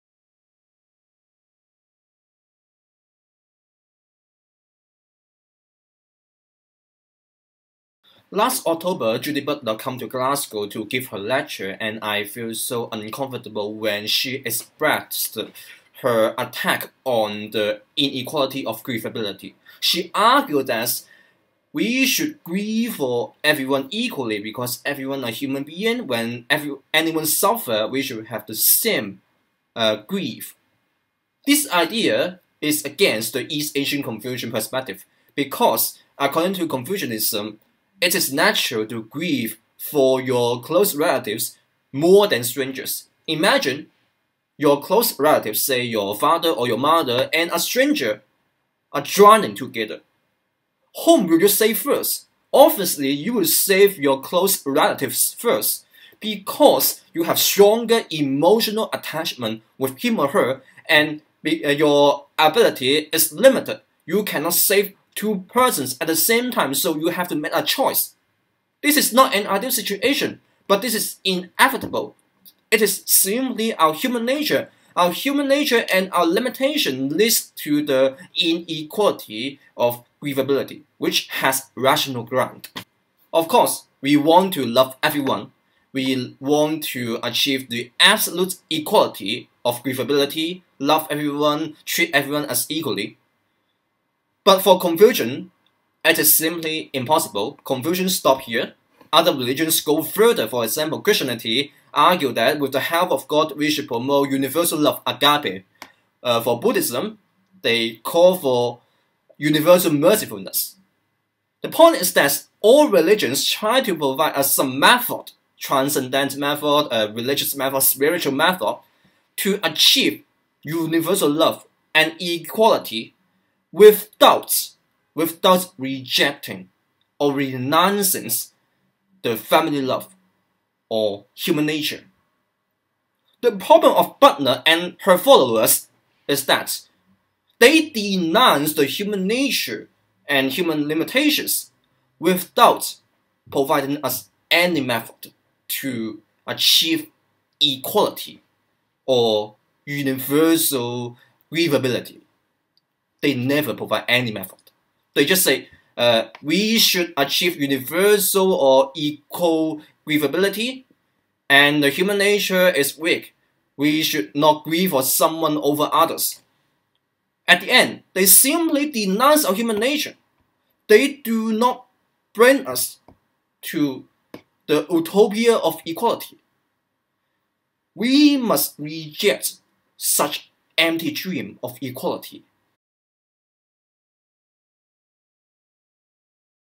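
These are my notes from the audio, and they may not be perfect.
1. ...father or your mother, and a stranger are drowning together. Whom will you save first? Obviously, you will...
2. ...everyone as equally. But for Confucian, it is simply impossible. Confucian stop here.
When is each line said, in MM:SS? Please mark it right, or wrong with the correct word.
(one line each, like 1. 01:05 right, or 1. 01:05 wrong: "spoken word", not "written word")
1. 00:46 right
2. 01:32 right.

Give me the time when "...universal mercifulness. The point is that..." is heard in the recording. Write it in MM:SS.
01:49.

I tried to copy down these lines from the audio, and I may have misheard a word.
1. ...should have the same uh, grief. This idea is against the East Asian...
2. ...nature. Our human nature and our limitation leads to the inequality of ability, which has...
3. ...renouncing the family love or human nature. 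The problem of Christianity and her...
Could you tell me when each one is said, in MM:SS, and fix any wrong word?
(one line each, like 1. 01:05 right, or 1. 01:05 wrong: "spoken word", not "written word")
1. 00:28 right
2. 01:14 wrong: "grievability", not "ability"
3. 02:07 wrong: "Butler", not "Christianity".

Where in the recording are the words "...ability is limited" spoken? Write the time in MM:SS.
01:02.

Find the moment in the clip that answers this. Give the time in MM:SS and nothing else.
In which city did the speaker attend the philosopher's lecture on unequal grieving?
00:10.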